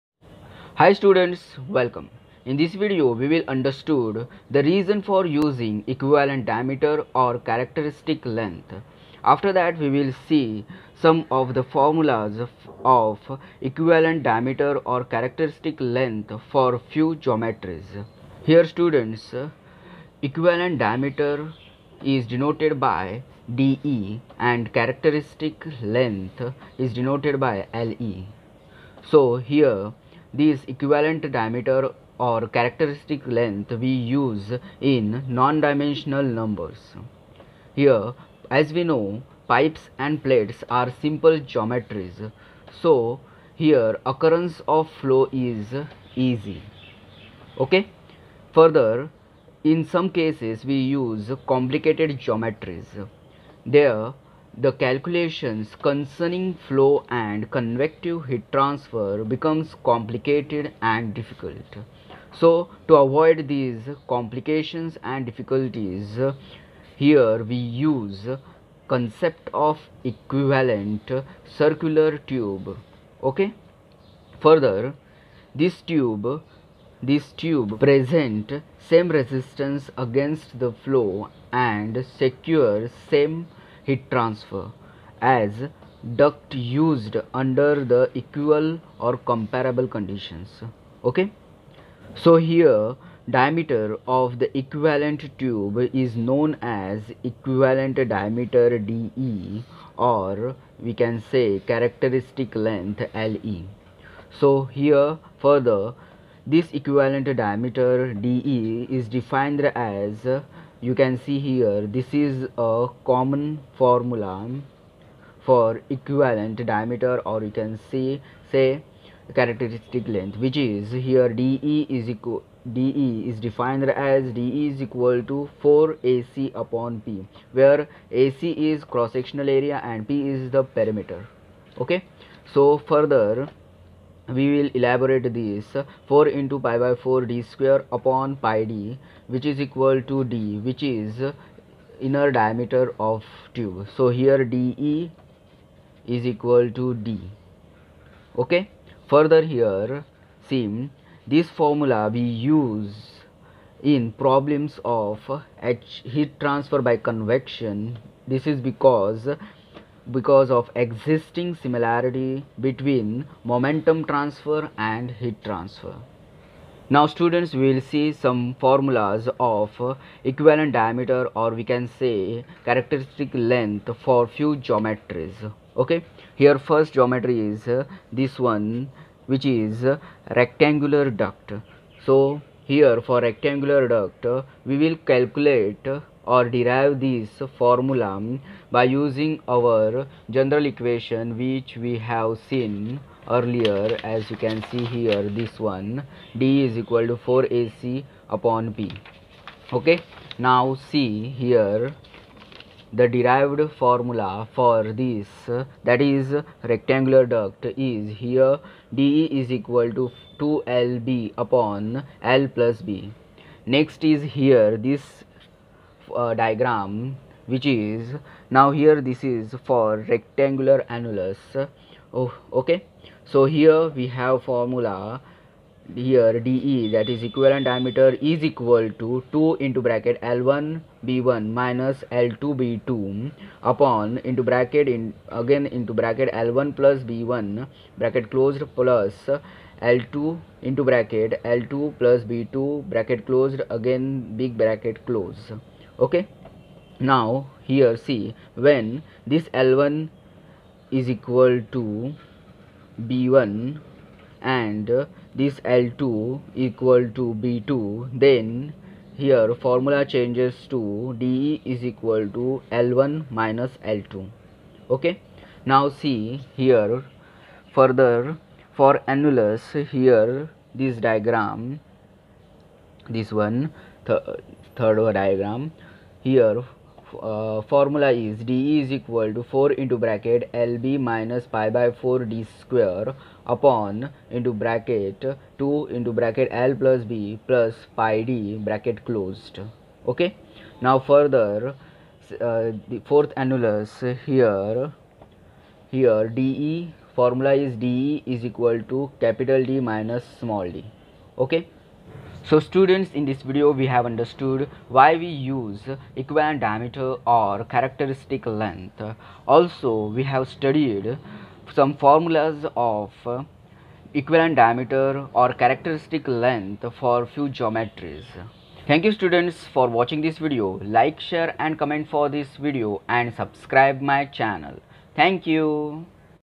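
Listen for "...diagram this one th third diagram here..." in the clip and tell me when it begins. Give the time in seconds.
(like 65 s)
271 s.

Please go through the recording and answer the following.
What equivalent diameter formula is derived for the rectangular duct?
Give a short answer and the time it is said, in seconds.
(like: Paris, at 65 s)
2LB/(L+B), at 210 s.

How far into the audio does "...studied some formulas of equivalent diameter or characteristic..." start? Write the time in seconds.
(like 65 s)
310 s.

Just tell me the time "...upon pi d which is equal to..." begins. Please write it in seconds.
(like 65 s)
137 s.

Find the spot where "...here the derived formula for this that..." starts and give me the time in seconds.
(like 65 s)
201 s.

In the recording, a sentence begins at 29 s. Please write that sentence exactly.
So here these equivalent diameter or characteristic length we use in non-dimensional numbers.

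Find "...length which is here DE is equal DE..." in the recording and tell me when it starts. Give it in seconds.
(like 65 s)
120 s.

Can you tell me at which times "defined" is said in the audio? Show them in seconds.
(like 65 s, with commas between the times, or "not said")
109 s, 123 s.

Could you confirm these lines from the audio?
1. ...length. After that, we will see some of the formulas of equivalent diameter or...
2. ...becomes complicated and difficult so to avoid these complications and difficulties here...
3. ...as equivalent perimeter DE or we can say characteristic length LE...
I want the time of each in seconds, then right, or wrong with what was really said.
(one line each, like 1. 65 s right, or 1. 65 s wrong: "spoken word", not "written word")
1. 8 s right
2. 59 s right
3. 96 s wrong: "diameter", not "perimeter".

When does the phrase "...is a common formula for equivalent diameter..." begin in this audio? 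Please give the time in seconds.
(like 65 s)
112 s.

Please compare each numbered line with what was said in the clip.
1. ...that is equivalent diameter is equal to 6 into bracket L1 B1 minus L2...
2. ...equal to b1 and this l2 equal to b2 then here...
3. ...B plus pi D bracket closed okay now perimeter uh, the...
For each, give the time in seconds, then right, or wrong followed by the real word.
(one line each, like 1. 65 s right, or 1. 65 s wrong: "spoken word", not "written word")
1. 226 s wrong: "2", not "6"
2. 251 s right
3. 287 s wrong: "further", not "perimeter".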